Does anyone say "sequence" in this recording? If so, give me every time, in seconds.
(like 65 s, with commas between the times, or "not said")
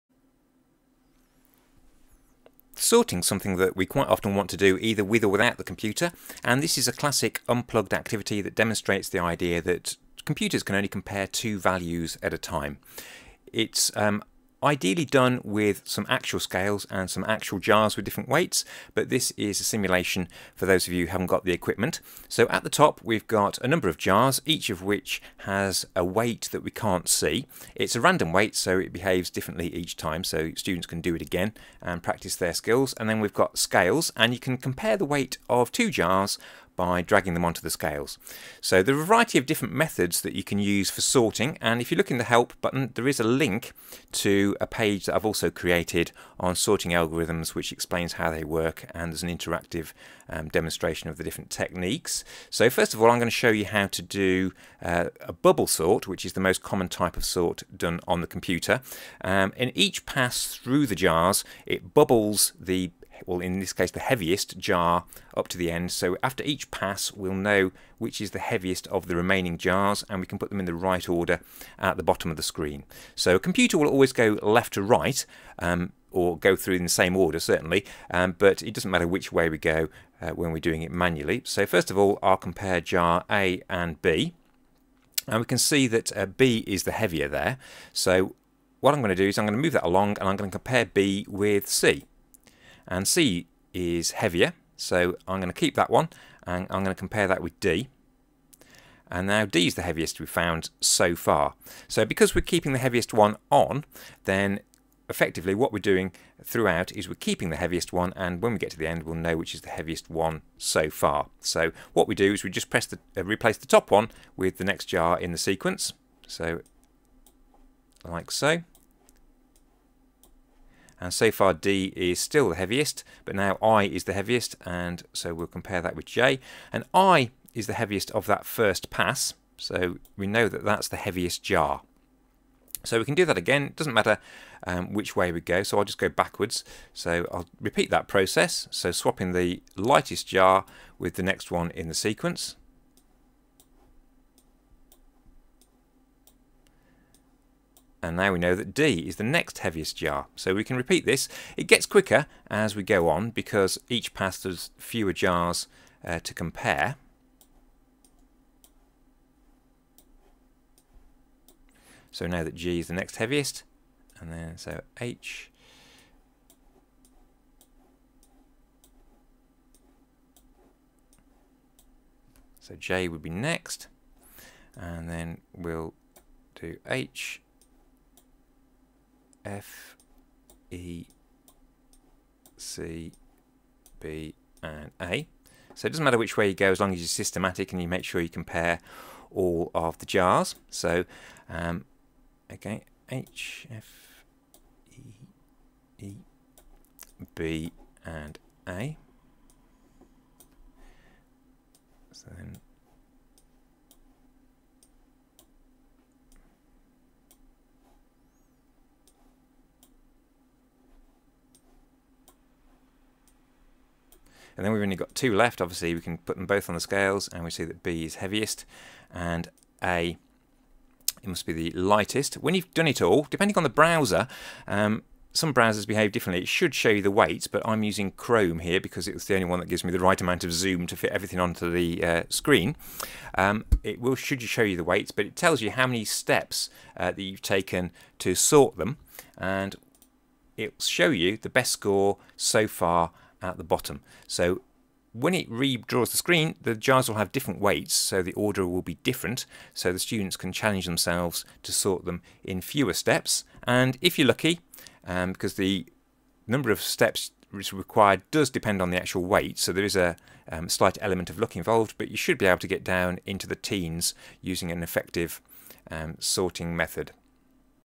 115 s, 141 s.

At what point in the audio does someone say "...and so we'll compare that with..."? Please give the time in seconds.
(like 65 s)
124 s.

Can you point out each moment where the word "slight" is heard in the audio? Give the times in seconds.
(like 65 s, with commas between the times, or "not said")
260 s.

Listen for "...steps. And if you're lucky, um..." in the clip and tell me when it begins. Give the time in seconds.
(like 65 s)
252 s.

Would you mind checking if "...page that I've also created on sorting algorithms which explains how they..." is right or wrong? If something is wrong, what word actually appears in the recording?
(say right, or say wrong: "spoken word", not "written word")
right.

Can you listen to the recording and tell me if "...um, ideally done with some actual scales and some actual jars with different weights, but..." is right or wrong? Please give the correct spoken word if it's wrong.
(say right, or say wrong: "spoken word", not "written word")
right.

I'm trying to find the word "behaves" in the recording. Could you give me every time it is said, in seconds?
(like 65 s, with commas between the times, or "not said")
28 s, 225 s.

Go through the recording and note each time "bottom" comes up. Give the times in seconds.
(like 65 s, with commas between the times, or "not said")
72 s, 243 s.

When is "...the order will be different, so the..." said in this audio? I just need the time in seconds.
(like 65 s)
248 s.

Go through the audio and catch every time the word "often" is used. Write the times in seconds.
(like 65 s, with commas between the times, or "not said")
4 s.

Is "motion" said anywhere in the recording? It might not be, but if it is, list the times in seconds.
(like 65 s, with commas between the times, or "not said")
not said.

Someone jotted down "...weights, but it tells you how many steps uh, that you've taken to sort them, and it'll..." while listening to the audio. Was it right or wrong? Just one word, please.
right.